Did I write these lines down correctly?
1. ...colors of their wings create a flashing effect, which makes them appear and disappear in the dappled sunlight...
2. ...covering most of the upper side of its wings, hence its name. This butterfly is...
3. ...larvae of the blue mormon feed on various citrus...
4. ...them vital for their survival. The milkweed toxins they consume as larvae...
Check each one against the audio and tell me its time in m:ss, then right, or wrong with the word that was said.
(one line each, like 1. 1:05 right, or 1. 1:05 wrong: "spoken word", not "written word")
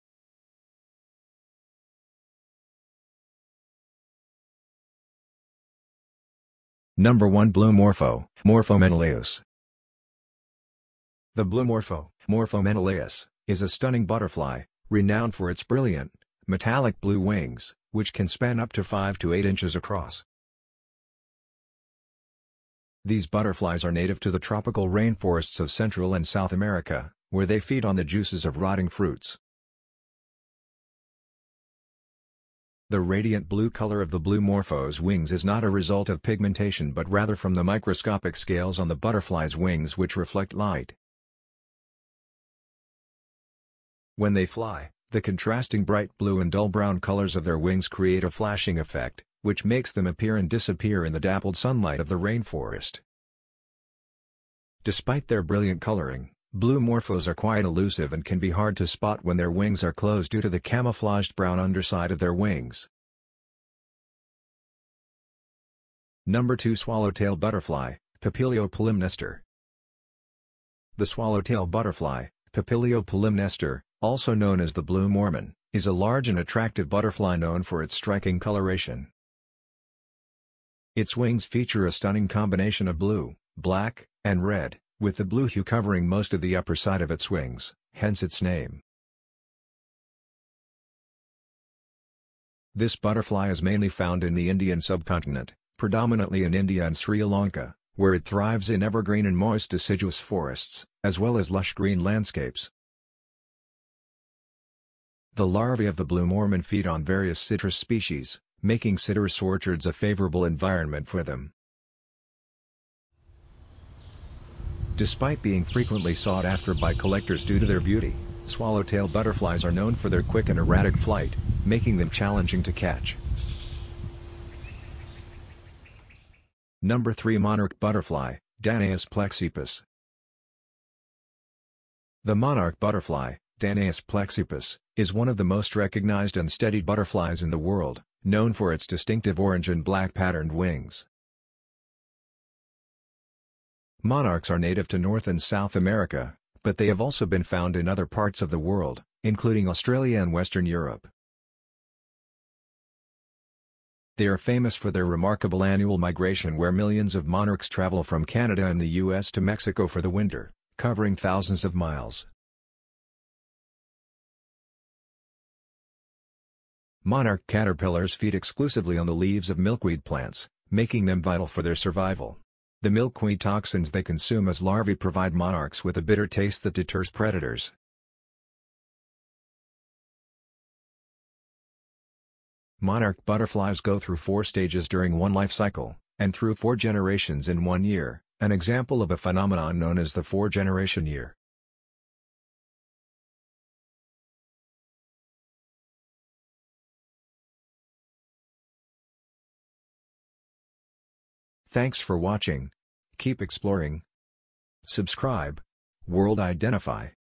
1. 0:46 right
2. 1:25 right
3. 1:45 right
4. 2:51 right.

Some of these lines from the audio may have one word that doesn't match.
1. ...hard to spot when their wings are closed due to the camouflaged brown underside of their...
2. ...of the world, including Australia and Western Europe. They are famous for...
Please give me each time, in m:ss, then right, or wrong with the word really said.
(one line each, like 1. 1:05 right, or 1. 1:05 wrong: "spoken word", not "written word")
1. 0:58 right
2. 2:28 right.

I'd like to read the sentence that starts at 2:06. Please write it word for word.
Number 3 Monarch Butterfly, Danaus plexippus.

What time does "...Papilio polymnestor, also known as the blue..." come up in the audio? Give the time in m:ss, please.
1:12.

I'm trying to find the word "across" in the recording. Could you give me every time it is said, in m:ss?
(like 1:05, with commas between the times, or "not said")
0:19.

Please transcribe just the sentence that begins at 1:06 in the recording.
Number 2 Swallowtail Butterfly, Papilio polymnestor.